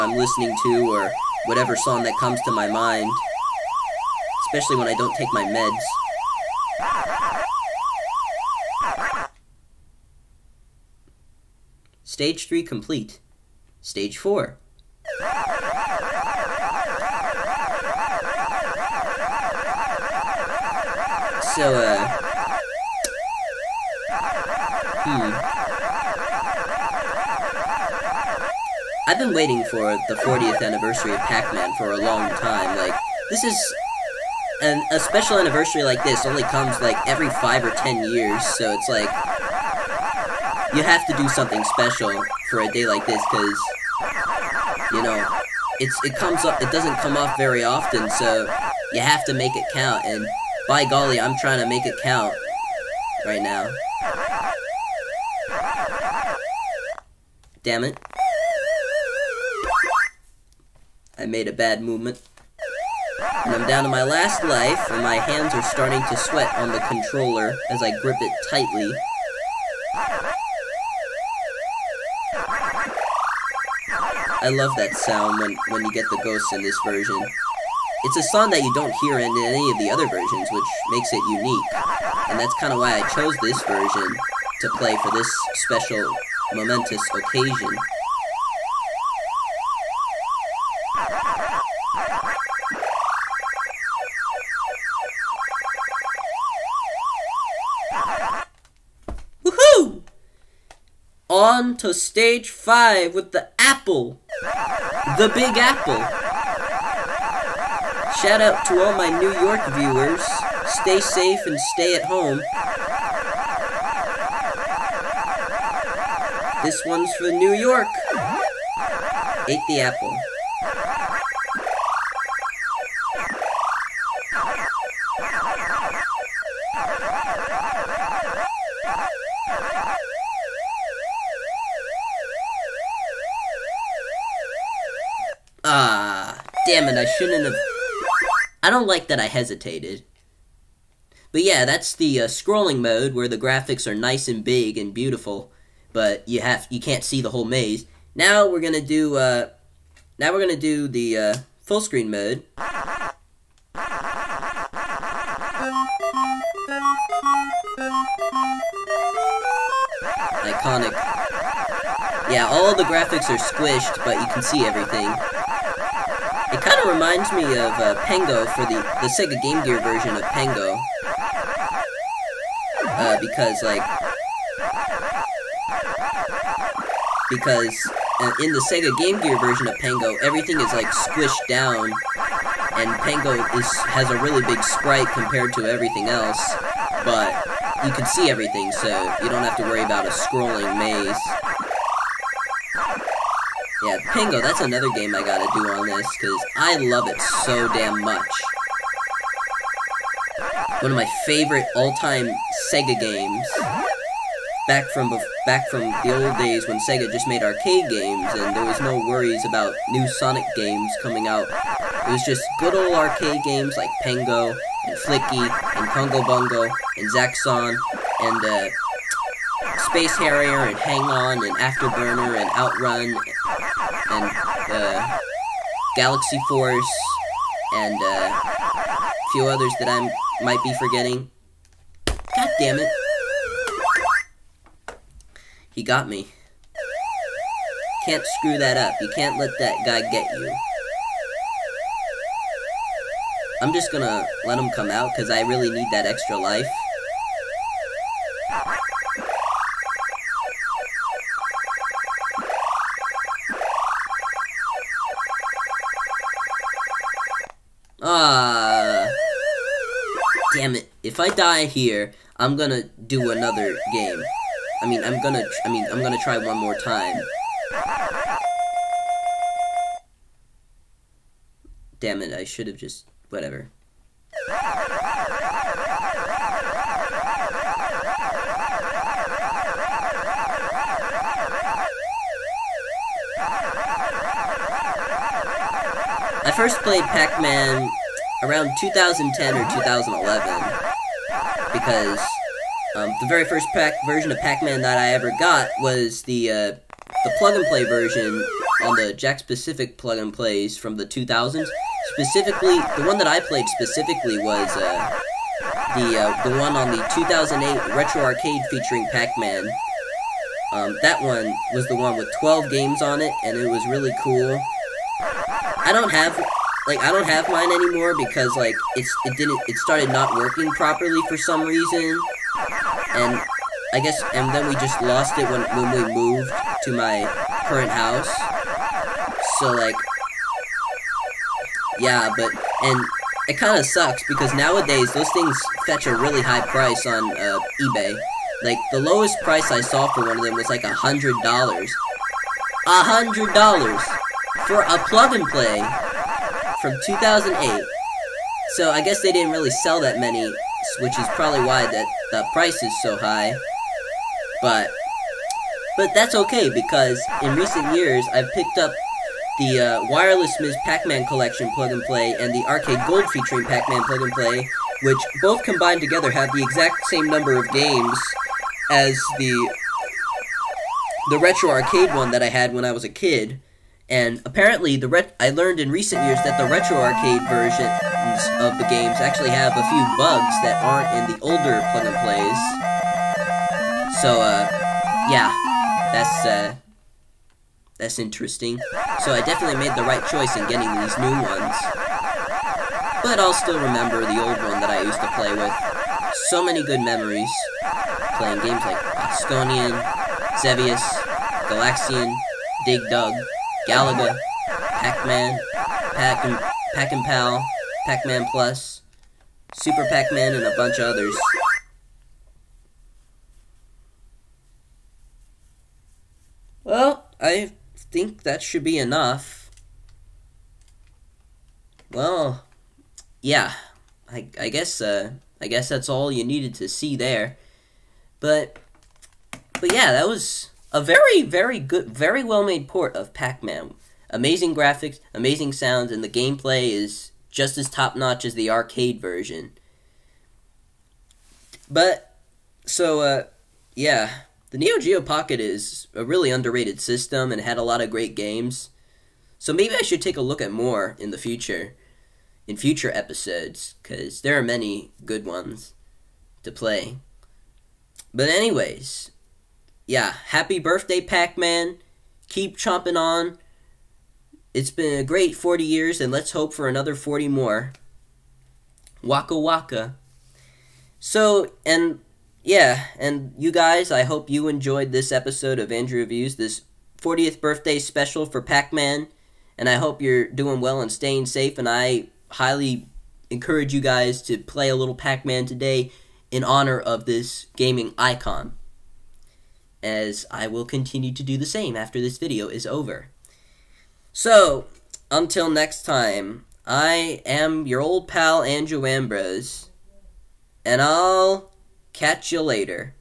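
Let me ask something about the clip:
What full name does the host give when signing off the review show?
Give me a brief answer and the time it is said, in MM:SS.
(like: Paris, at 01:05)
Andrew Ambrose, at 08:18.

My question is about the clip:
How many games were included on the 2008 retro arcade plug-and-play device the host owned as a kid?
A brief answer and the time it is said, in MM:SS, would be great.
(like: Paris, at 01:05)
12, at 05:12.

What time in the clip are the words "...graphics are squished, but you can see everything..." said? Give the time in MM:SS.
02:42.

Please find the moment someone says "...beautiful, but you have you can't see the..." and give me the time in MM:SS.
02:24.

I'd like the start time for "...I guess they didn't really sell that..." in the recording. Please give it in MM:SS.
05:48.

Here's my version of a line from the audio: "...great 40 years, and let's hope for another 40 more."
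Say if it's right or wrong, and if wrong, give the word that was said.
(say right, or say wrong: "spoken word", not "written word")
right.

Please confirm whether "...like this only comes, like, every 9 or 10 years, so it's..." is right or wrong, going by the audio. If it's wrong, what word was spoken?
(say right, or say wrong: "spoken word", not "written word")
wrong: "5", not "9".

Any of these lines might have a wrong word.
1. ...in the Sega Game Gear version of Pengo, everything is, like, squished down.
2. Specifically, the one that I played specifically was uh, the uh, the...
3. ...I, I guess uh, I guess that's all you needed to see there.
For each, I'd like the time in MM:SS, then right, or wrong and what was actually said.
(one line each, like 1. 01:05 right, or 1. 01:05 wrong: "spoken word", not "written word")
1. 02:58 right
2. 05:02 right
3. 07:04 right.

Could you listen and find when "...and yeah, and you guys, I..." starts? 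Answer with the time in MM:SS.
07:51.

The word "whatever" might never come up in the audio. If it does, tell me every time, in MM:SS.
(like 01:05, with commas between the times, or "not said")
00:01, 04:33.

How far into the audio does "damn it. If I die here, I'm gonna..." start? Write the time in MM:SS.
04:20.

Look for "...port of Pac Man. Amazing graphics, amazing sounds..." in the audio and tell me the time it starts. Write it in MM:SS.
07:12.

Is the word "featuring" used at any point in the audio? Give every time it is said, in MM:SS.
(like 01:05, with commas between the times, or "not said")
05:08, 06:03.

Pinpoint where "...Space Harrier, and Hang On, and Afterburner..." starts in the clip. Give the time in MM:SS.
03:39.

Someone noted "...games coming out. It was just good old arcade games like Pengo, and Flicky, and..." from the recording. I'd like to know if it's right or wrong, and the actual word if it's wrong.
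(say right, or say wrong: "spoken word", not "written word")
right.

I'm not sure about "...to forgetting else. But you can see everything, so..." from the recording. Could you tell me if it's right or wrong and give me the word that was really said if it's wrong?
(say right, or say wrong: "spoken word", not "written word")
wrong: "everything", not "forgetting".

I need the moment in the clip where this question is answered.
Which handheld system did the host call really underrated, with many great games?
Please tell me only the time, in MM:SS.
07:24.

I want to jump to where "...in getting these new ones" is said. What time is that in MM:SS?
06:30.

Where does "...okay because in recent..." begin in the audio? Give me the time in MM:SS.
05:56.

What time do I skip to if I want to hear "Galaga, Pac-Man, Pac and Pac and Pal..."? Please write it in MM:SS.
06:43.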